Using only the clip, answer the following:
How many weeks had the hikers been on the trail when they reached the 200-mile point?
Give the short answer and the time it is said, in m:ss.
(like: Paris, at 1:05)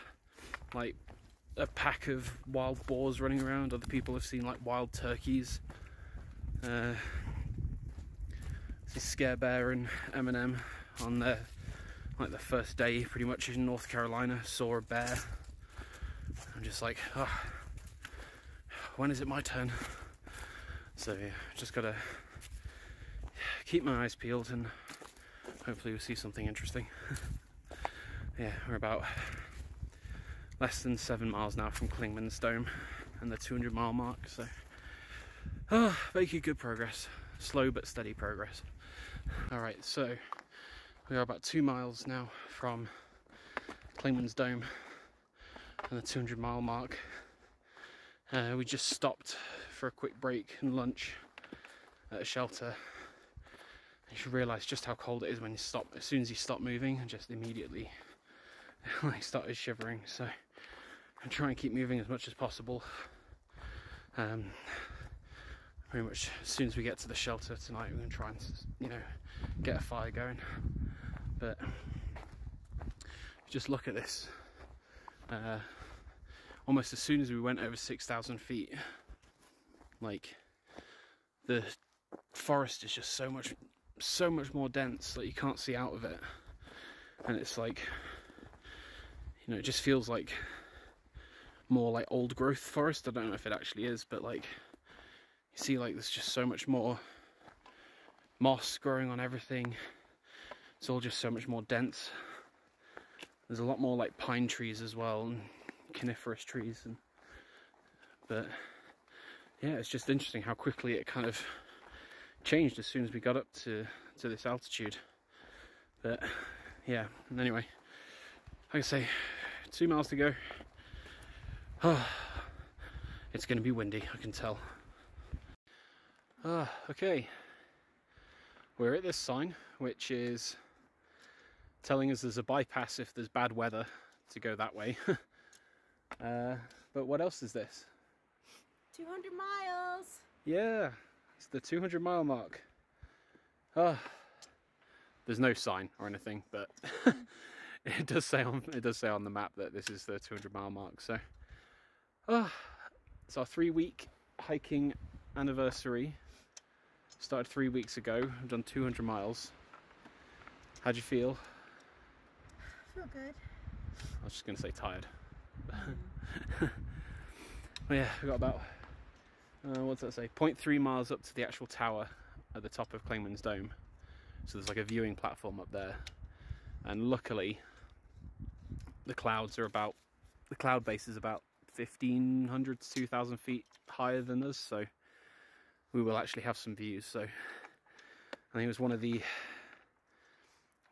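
3 weeks, at 2:33.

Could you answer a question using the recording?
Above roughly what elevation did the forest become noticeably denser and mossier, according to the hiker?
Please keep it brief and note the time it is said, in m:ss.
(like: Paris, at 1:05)
6,000 feet, at 1:17.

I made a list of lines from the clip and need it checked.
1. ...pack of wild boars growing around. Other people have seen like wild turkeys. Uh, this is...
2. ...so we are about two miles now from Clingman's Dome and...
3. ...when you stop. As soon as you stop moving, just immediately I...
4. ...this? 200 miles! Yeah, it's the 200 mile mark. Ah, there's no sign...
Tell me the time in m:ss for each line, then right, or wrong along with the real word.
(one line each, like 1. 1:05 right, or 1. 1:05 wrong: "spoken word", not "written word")
1. 0:01 wrong: "running", not "growing"
2. 0:39 right
3. 0:55 right
4. 2:17 right.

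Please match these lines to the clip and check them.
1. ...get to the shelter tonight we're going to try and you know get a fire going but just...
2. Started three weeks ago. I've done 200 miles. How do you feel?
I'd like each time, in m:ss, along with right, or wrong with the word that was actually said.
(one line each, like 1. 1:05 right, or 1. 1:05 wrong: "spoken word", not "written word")
1. 1:06 right
2. 2:37 right.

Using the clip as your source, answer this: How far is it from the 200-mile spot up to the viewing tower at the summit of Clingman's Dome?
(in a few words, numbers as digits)
0.3 miles.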